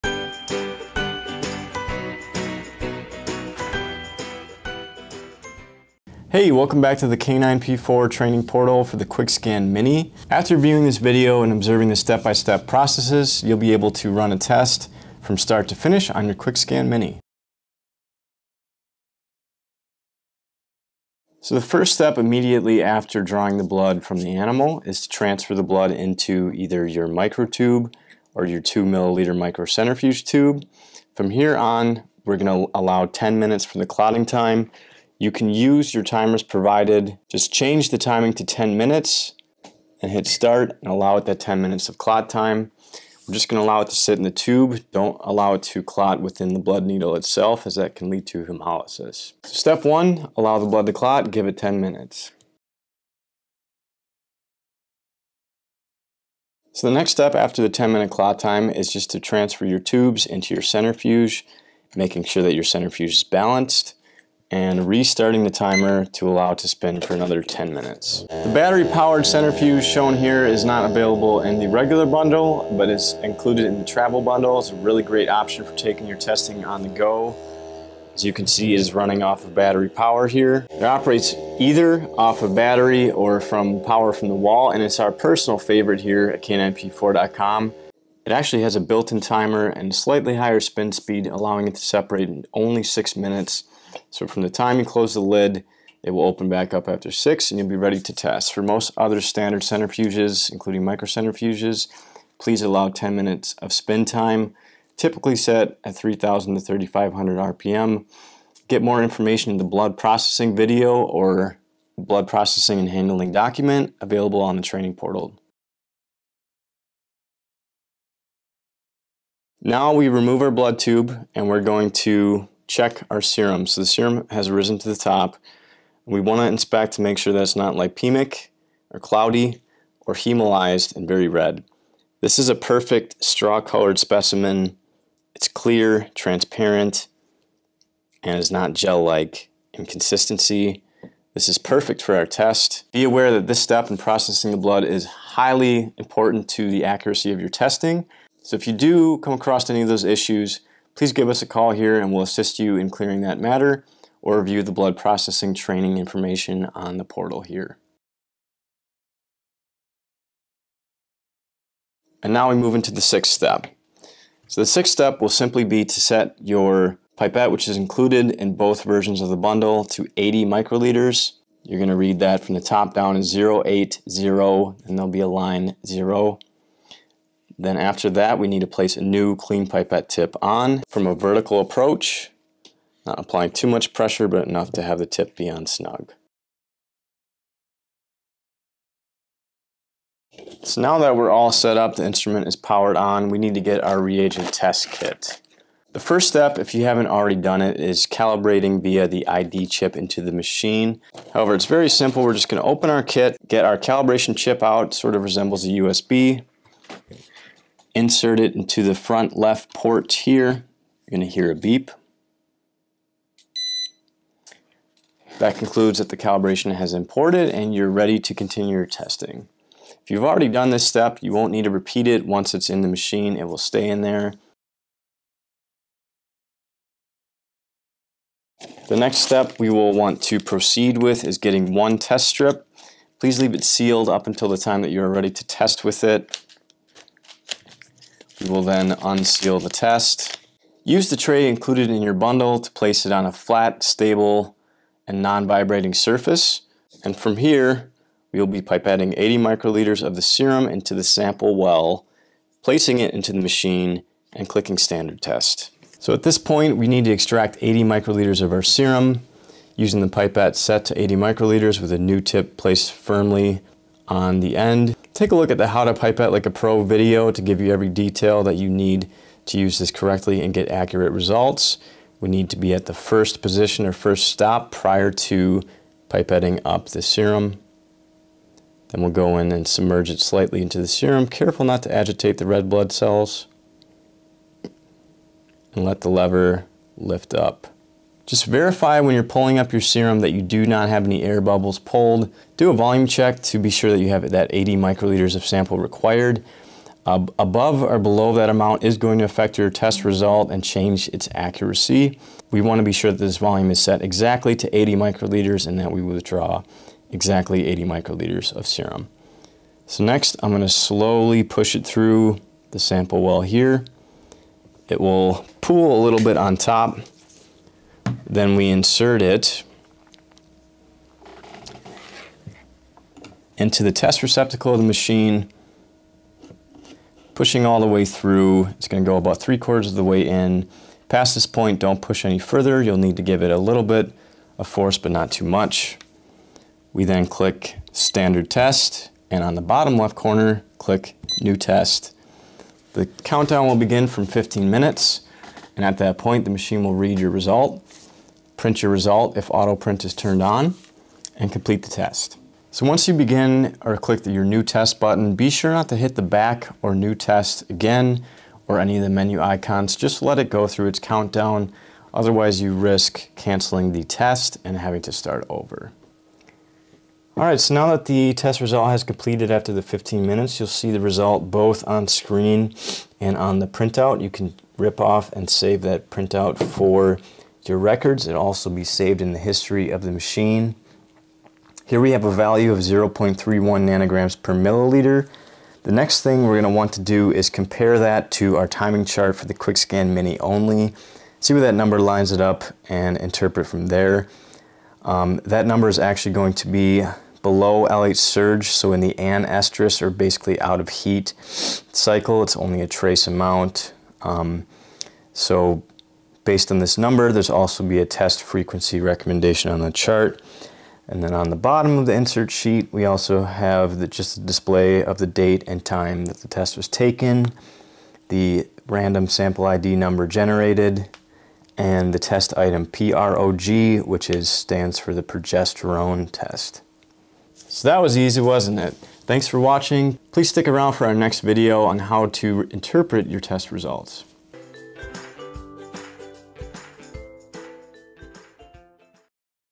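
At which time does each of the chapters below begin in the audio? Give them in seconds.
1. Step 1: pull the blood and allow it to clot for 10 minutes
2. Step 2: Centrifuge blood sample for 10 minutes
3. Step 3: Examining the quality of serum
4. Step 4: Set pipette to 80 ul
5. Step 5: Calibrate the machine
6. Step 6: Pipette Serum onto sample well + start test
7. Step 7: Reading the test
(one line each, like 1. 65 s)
1. 19 s
2. 53 s
3. 116 s
4. 159 s
5. 187 s
6. 225 s
7. 366 s.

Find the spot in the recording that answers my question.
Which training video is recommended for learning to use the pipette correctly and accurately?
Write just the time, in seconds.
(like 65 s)
265 s.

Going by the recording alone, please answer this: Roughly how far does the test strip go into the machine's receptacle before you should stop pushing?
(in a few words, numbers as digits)
Three quarters.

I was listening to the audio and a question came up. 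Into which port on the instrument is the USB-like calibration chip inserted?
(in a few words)
Front left port.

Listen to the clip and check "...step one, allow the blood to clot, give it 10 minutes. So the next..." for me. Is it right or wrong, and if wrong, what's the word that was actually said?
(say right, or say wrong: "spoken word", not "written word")
right.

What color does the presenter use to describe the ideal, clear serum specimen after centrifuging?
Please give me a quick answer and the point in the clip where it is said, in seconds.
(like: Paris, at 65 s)
Straw-colored, at 133 s.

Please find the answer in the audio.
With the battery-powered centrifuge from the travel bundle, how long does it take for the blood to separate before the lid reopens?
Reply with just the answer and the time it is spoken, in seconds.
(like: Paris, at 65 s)
6 minutes, at 92 s.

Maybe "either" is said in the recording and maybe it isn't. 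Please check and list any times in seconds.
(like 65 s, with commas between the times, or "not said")
26 s, 81 s.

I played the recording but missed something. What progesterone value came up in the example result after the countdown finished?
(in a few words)
0.31 ng/mL.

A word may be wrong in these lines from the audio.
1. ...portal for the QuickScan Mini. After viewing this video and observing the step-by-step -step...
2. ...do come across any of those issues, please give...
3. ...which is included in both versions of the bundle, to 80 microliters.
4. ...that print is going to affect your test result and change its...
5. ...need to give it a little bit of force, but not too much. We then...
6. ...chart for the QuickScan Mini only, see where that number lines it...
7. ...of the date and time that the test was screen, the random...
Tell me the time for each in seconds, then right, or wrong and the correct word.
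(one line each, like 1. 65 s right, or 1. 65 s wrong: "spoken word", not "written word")
1. 8 s right
2. 148 s right
3. 167 s right
4. 298 s wrong: "amount", not "print"
5. 332 s right
6. 389 s right
7. 415 s wrong: "taken", not "screen".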